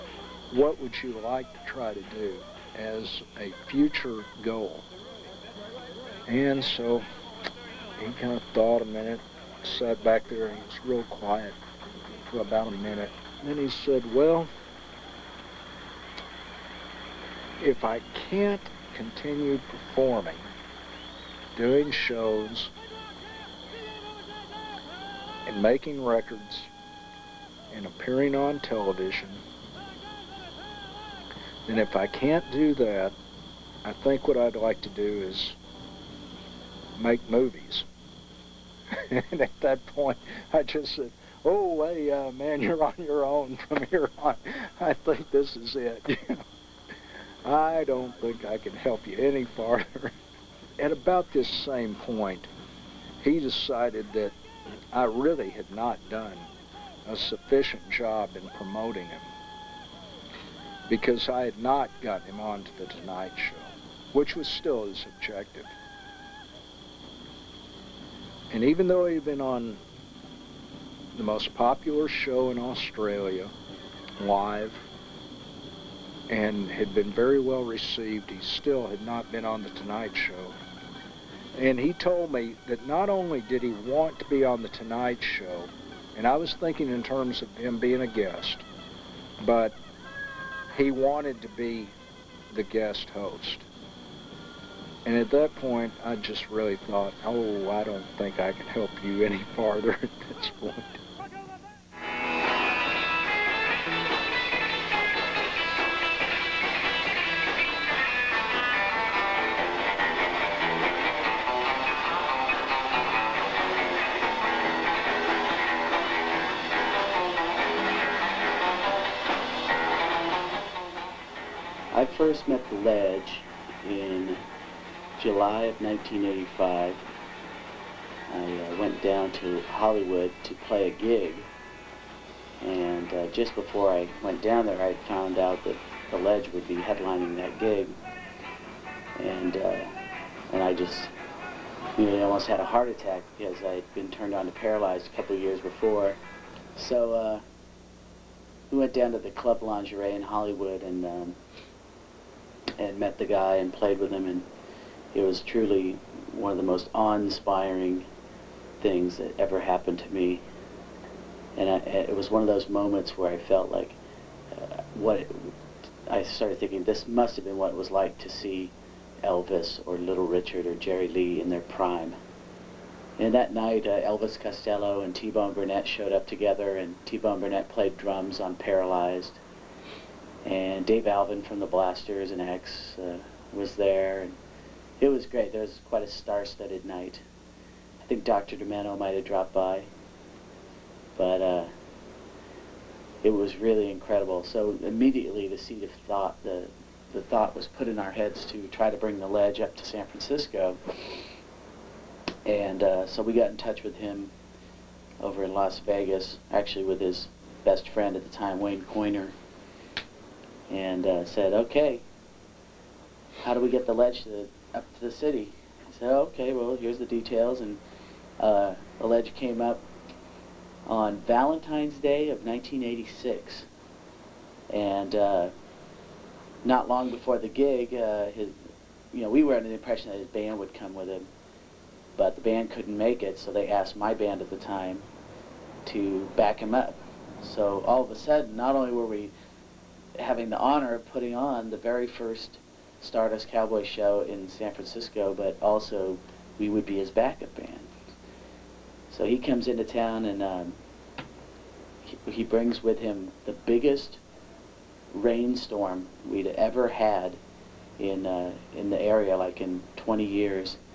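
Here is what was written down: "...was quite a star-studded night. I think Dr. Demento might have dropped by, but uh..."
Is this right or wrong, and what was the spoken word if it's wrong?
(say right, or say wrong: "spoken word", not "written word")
right.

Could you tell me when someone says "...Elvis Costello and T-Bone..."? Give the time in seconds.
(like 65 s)
173 s.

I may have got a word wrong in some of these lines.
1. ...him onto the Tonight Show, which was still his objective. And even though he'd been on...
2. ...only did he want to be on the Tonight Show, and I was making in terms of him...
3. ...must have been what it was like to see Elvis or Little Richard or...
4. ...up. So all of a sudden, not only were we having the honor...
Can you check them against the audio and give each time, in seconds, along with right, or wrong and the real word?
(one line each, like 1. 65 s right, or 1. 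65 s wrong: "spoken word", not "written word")
1. 62 s right
2. 83 s wrong: "thinking", not "making"
3. 167 s right
4. 236 s right.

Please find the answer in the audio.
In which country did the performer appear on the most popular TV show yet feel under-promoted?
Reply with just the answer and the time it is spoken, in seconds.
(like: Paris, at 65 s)
Australia, at 72 s.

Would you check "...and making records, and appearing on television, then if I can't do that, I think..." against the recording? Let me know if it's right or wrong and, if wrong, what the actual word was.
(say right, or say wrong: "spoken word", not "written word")
right.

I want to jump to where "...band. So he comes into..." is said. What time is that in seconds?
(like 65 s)
247 s.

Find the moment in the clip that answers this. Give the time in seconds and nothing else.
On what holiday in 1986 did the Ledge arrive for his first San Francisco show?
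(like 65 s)
221 s.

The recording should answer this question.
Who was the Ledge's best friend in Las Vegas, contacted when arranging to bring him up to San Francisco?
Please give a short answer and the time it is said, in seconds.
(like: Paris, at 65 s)
Wayne Coiner, at 208 s.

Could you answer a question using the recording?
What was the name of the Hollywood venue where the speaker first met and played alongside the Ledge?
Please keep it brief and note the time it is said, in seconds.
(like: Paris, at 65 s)
Club Lingerie, at 149 s.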